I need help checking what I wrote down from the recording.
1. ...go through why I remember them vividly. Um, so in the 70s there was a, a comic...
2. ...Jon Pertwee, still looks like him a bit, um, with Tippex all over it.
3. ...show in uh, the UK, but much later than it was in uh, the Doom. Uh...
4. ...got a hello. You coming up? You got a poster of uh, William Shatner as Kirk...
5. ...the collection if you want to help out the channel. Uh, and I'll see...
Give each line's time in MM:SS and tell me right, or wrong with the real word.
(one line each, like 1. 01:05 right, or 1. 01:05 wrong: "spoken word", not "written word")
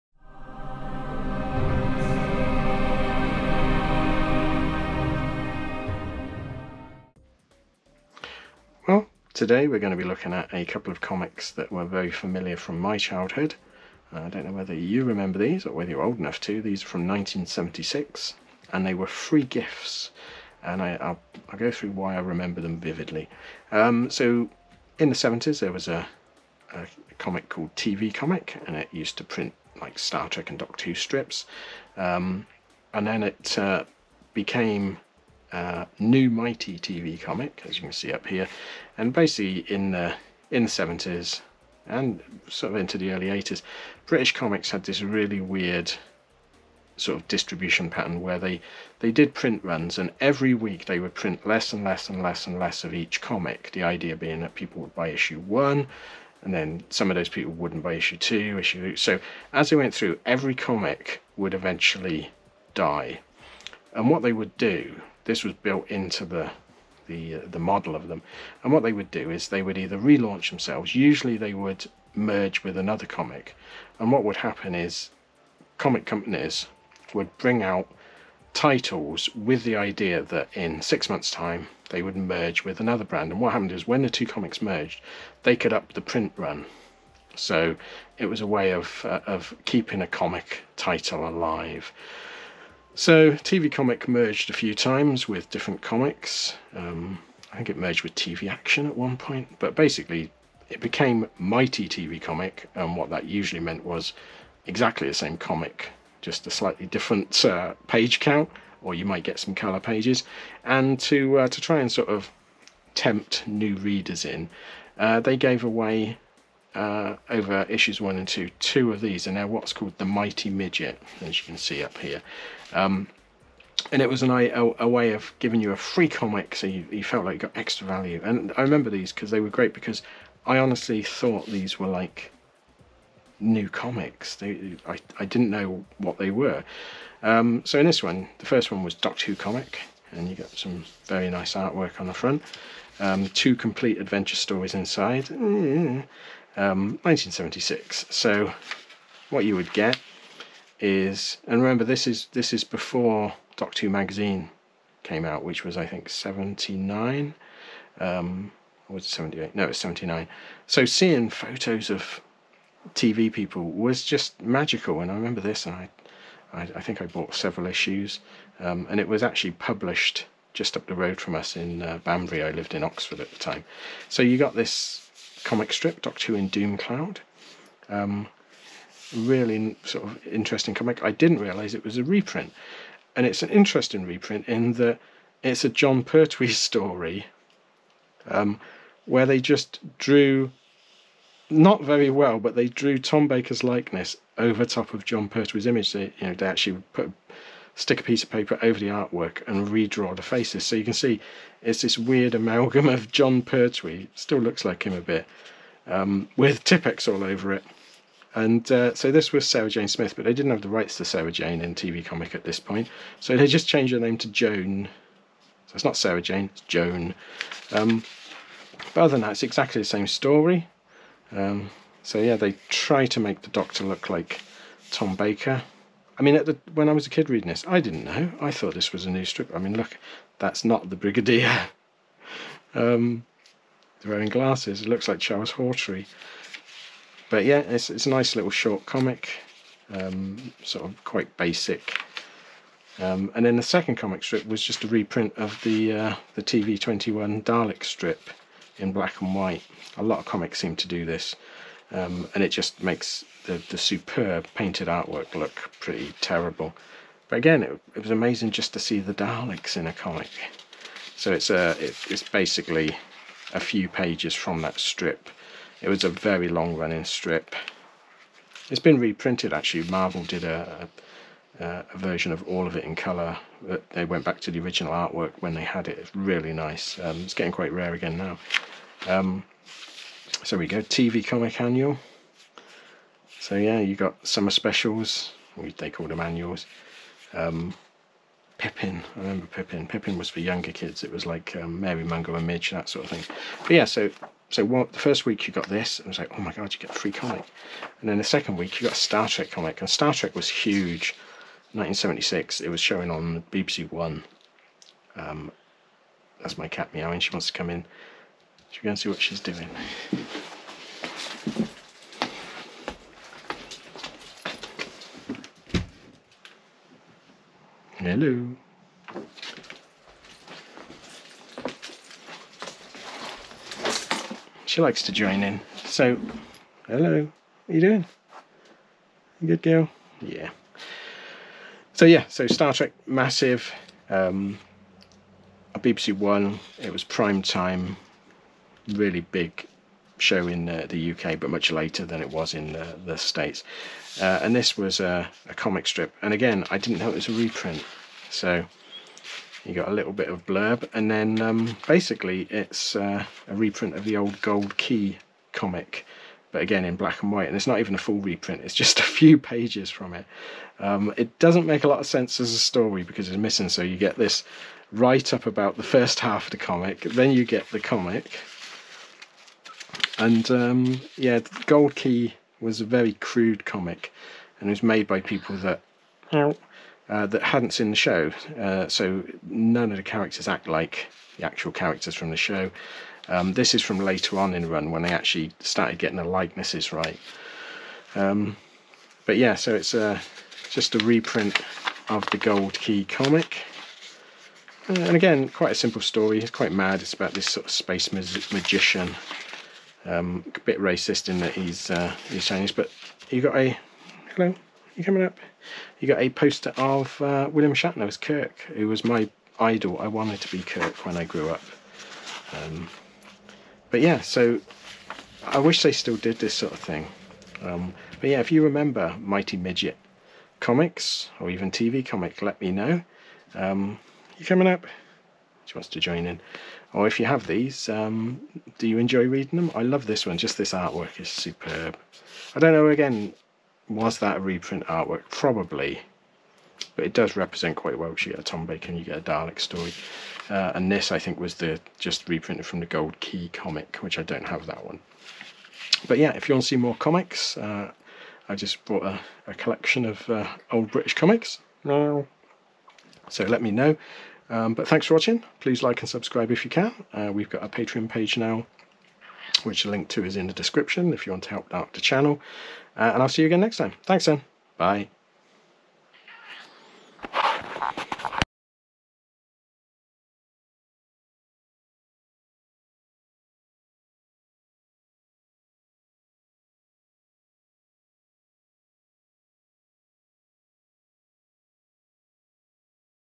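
1. 00:21 right
2. 03:23 right
3. 05:40 wrong: "States", not "Doom"
4. 06:43 right
5. 07:40 wrong: "description", not "collection".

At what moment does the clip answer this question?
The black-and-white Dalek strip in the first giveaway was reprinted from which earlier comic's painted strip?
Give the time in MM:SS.
04:06.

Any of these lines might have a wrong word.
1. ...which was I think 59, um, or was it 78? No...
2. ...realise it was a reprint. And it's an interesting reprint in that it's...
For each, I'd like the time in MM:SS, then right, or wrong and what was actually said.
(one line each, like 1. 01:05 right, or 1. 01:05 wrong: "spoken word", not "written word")
1. 02:35 wrong: "79", not "59"
2. 03:01 right.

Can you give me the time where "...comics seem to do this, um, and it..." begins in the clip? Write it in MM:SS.
04:10.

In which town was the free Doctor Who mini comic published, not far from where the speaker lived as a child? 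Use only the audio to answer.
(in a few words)
Banbury.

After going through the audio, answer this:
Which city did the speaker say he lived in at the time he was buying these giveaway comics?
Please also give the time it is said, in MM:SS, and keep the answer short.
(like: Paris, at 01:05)
Oxford, at 02:52.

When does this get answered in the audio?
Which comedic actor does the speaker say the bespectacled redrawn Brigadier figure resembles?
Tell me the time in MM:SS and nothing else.
03:55.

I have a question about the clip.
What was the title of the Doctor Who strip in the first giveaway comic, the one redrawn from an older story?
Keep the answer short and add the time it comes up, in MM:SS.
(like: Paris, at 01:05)
Doom Cloud, at 02:56.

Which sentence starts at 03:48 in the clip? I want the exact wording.
I thought this was a new strip.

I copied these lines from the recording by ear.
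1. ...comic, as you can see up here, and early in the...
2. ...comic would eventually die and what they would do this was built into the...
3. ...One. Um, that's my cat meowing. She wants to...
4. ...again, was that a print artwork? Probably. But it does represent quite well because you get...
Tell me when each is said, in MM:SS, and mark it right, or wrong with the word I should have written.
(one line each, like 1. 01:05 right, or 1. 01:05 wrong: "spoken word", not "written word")
1. 00:37 wrong: "basically", not "early"
2. 01:00 right
3. 05:03 right
4. 07:12 wrong: "reprint", not "print".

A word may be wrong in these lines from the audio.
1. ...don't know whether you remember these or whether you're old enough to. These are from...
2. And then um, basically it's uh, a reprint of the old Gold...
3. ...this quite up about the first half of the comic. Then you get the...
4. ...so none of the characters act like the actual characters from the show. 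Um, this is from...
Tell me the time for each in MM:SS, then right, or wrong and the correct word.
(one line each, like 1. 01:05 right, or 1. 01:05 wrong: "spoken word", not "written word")
1. 00:14 right
2. 05:50 right
3. 06:04 wrong: "write", not "quite"
4. 06:18 right.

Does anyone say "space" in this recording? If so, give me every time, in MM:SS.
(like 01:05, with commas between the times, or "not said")
06:37.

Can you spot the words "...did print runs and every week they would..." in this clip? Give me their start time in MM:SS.
00:49.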